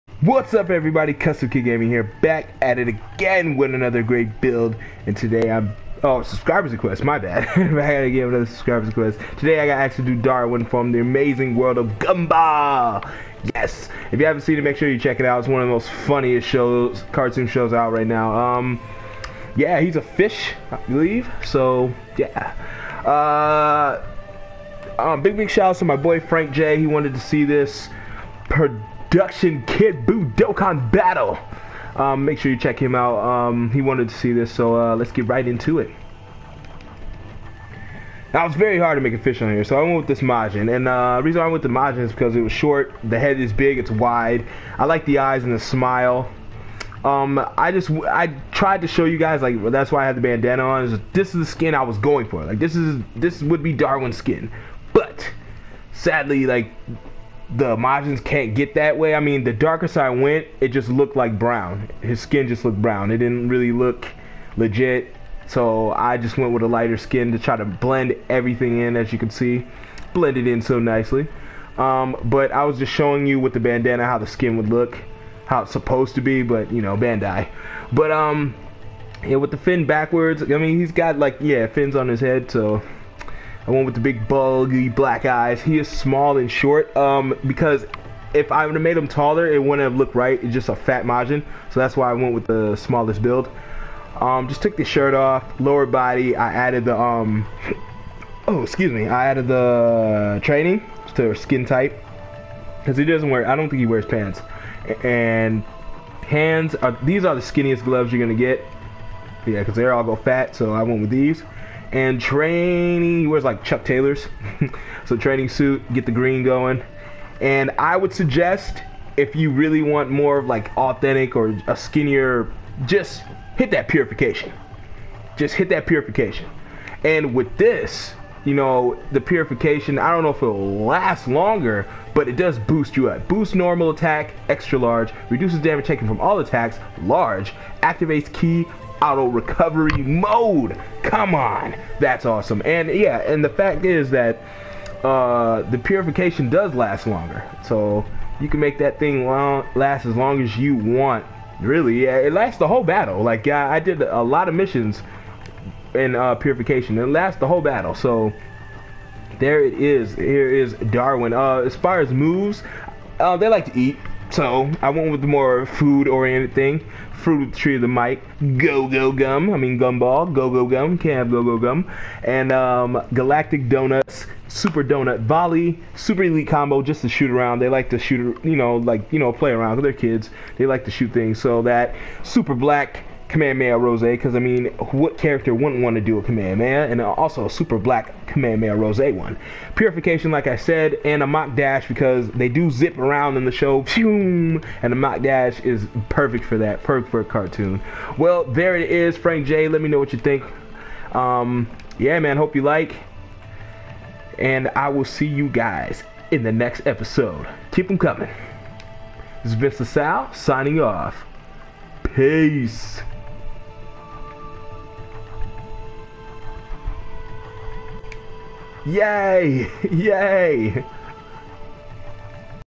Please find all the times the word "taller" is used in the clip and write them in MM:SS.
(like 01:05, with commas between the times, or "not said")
01:29.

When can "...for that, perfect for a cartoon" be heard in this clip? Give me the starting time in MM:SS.
03:16.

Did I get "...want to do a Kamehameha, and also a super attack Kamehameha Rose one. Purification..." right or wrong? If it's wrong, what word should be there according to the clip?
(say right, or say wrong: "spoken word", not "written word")
wrong: "black", not "attack".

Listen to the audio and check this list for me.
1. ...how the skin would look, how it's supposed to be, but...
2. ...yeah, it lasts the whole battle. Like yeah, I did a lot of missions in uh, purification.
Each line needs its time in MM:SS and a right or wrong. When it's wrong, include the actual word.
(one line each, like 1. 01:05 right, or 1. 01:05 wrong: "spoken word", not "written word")
1. 01:14 right
2. 02:32 right.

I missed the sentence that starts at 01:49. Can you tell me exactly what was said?
Yeah, because they're all go fat, so I went with these.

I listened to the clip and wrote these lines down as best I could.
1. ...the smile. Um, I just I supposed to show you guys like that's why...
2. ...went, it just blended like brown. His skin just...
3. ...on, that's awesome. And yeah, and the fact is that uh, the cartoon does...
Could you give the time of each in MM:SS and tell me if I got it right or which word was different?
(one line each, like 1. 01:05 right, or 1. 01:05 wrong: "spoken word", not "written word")
1. 00:45 wrong: "tried", not "supposed"
2. 01:00 wrong: "looked", not "blended"
3. 02:21 wrong: "purification", not "cartoon".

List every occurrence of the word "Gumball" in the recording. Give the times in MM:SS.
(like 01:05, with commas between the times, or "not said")
00:11, 02:49.